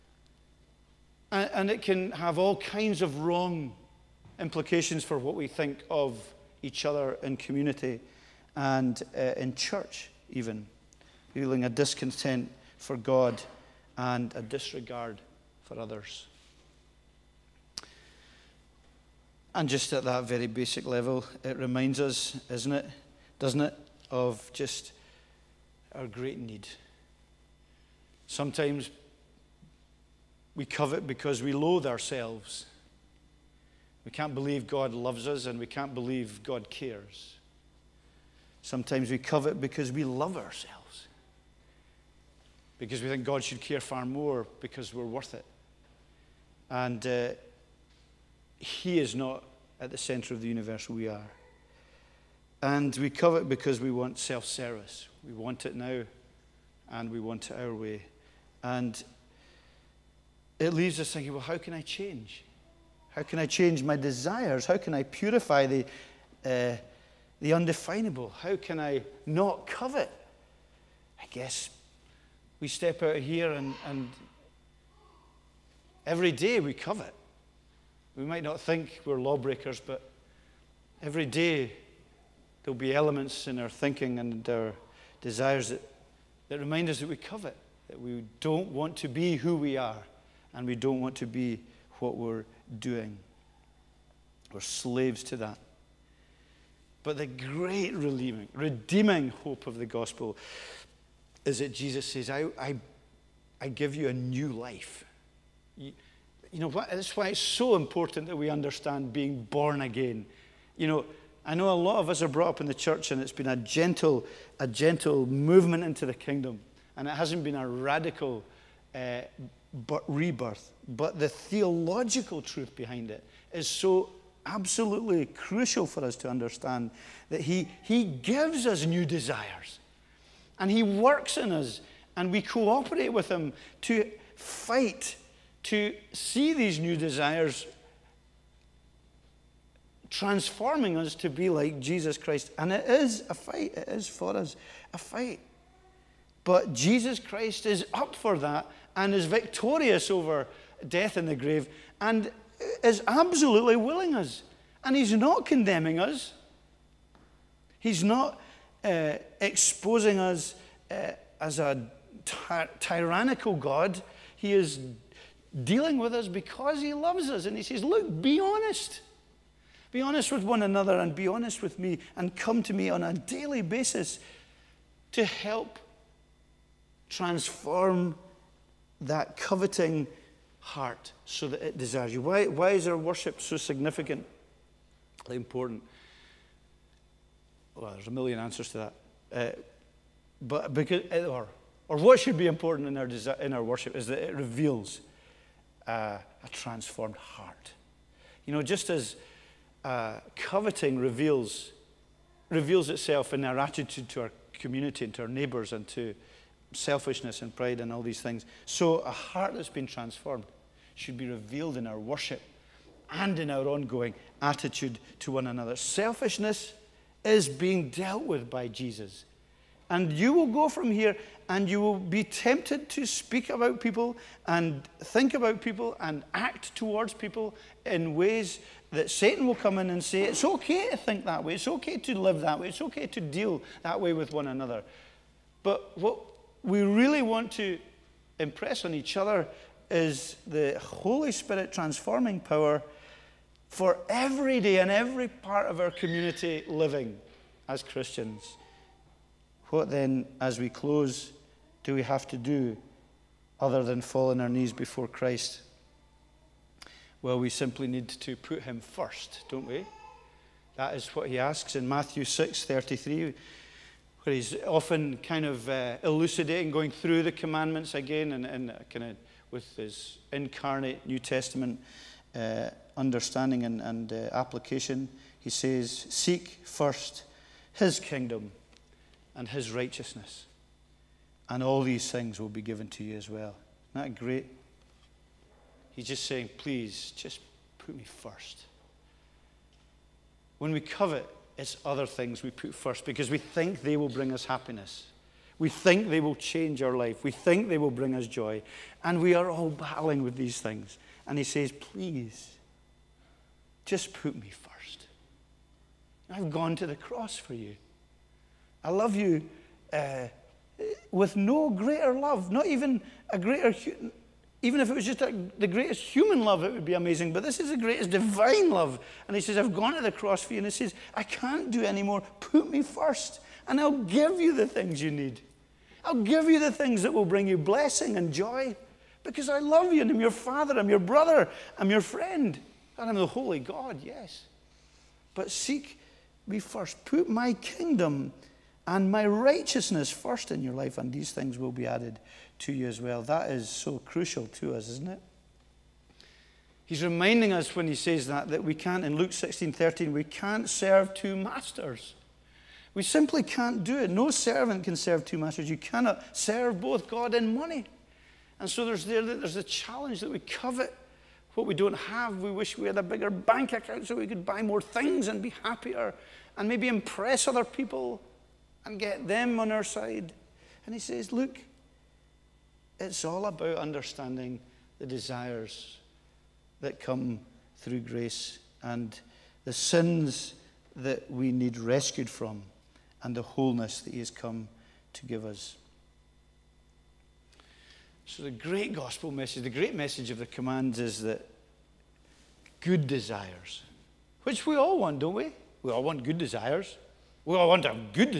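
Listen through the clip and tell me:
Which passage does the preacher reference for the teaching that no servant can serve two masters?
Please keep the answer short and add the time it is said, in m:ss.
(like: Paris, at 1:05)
Luke 16:13, at 5:49.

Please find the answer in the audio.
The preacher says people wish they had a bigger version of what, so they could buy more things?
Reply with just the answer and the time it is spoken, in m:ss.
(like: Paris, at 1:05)
bank account, at 6:03.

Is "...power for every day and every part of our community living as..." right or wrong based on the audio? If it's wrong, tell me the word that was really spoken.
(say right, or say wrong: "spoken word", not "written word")
right.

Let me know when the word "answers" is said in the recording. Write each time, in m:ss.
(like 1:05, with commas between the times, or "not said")
3:08.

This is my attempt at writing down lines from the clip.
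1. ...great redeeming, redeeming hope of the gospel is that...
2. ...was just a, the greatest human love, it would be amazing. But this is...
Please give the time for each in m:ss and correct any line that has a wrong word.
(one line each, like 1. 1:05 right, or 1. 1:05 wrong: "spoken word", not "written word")
1. 1:37 right
2. 5:14 right.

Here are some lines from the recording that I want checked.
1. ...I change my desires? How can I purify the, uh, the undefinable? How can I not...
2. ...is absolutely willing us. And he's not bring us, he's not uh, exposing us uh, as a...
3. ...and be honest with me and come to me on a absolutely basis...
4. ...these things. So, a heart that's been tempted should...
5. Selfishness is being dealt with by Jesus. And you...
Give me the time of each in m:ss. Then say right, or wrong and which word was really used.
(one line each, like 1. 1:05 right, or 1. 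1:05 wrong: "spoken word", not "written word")
1. 1:03 right
2. 2:32 wrong: "condemning", not "bring"
3. 2:50 wrong: "daily", not "absolutely"
4. 3:28 wrong: "transformed", not "tempted"
5. 3:35 right.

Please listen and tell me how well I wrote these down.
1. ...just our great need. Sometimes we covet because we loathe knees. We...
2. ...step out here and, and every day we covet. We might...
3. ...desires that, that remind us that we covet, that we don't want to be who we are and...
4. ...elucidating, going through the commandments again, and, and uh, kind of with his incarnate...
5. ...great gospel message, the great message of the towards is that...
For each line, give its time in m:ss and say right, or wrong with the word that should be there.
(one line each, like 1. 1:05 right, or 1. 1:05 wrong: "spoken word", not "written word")
1. 0:24 wrong: "ourselves", not "knees"
2. 1:12 right
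3. 1:25 right
4. 4:26 right
5. 6:28 wrong: "commands", not "towards".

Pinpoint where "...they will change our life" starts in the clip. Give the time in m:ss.
4:56.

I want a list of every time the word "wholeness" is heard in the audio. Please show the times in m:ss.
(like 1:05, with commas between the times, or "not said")
6:23.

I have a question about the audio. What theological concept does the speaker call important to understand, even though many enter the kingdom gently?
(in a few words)
being born again.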